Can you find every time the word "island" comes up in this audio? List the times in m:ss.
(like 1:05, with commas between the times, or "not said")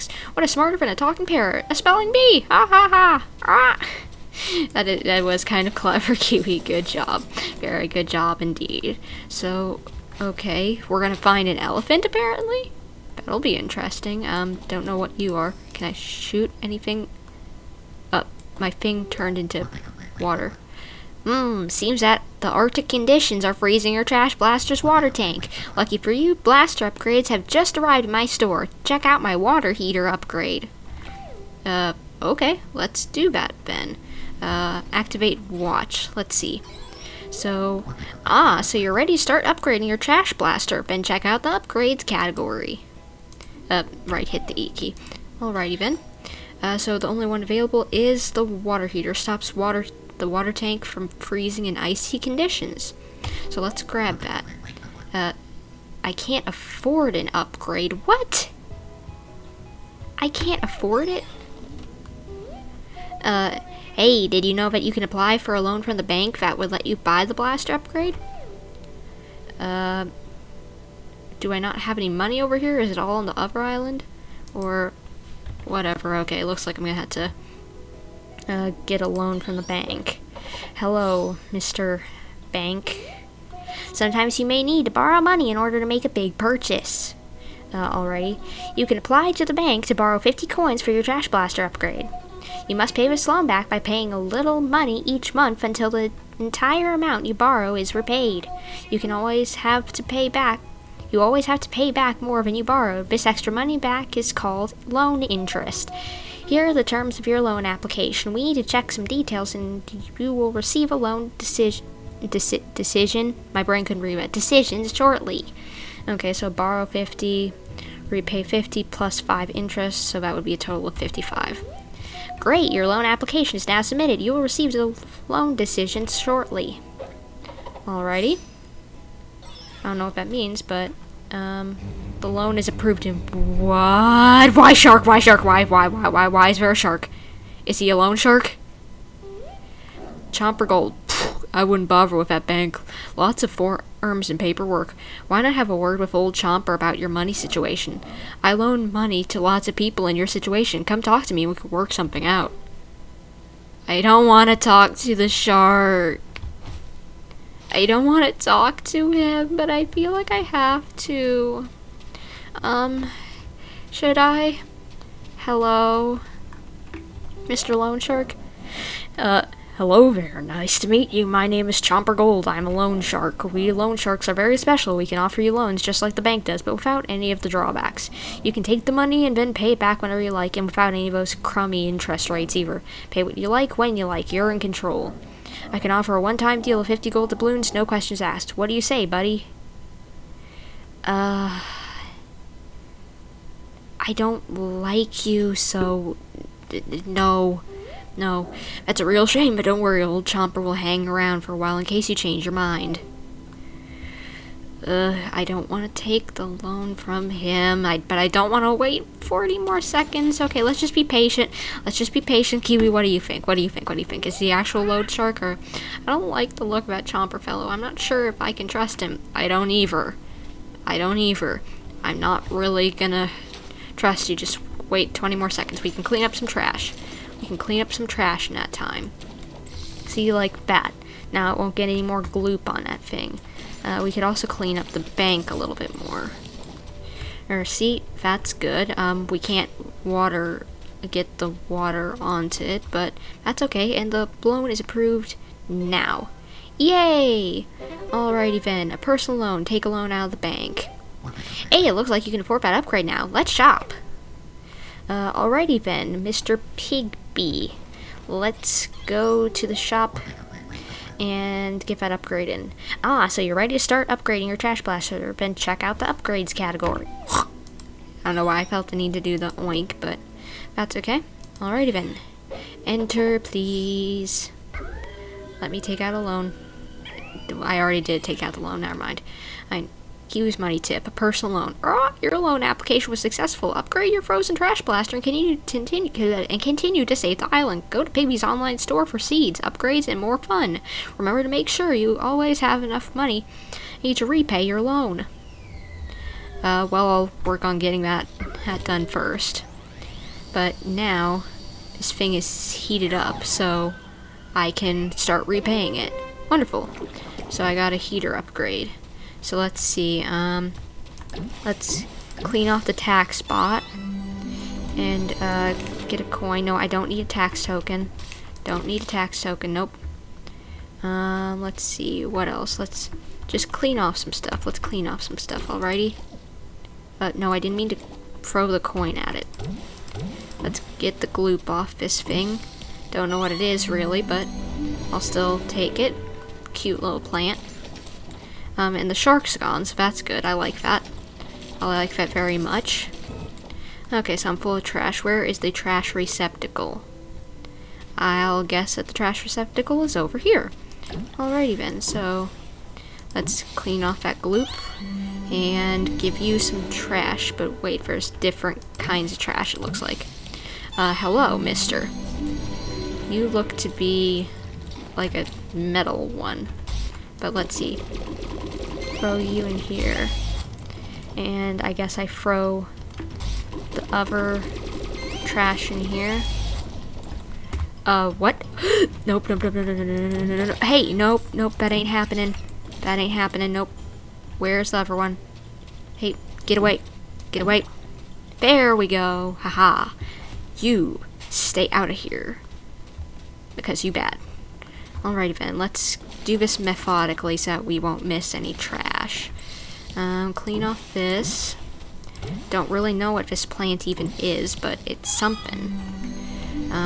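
1:13, 4:47.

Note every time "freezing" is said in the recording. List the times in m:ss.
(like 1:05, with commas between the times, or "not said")
0:23, 0:51.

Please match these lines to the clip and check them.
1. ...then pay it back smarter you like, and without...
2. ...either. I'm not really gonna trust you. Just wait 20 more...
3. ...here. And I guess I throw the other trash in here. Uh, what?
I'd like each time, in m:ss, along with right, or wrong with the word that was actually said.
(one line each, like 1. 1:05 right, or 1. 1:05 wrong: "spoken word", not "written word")
1. 2:59 wrong: "whenever", not "smarter"
2. 3:41 right
3. 6:09 right.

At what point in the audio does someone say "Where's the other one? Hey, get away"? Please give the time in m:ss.
6:24.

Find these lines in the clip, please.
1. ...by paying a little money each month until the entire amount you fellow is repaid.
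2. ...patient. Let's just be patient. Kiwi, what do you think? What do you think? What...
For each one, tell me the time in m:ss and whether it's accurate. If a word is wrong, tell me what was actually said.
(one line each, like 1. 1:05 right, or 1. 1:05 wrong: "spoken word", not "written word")
1. 1:33 wrong: "borrow", not "fellow"
2. 3:31 right.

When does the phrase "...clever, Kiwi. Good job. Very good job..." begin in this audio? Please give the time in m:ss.
0:05.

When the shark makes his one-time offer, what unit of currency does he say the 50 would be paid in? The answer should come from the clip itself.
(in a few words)
Gold doubloons.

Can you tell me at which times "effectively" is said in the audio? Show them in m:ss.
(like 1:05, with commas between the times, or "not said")
not said.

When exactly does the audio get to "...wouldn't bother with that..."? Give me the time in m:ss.
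2:21.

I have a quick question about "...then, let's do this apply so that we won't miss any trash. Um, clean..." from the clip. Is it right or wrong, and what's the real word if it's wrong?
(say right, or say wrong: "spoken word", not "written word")
wrong: "methodically", not "apply".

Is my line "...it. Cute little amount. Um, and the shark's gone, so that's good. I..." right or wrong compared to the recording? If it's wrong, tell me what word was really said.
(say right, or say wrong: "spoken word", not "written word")
wrong: "plant", not "amount".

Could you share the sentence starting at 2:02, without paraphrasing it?
Great, your loan application is now submitted.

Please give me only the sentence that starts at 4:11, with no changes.
Hey, it looks like you can afford that upgrade now.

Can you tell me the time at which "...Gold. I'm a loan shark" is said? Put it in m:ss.
2:52.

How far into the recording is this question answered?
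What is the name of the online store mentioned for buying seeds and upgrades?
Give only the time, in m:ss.
4:48.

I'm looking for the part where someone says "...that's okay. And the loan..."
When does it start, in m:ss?
4:03.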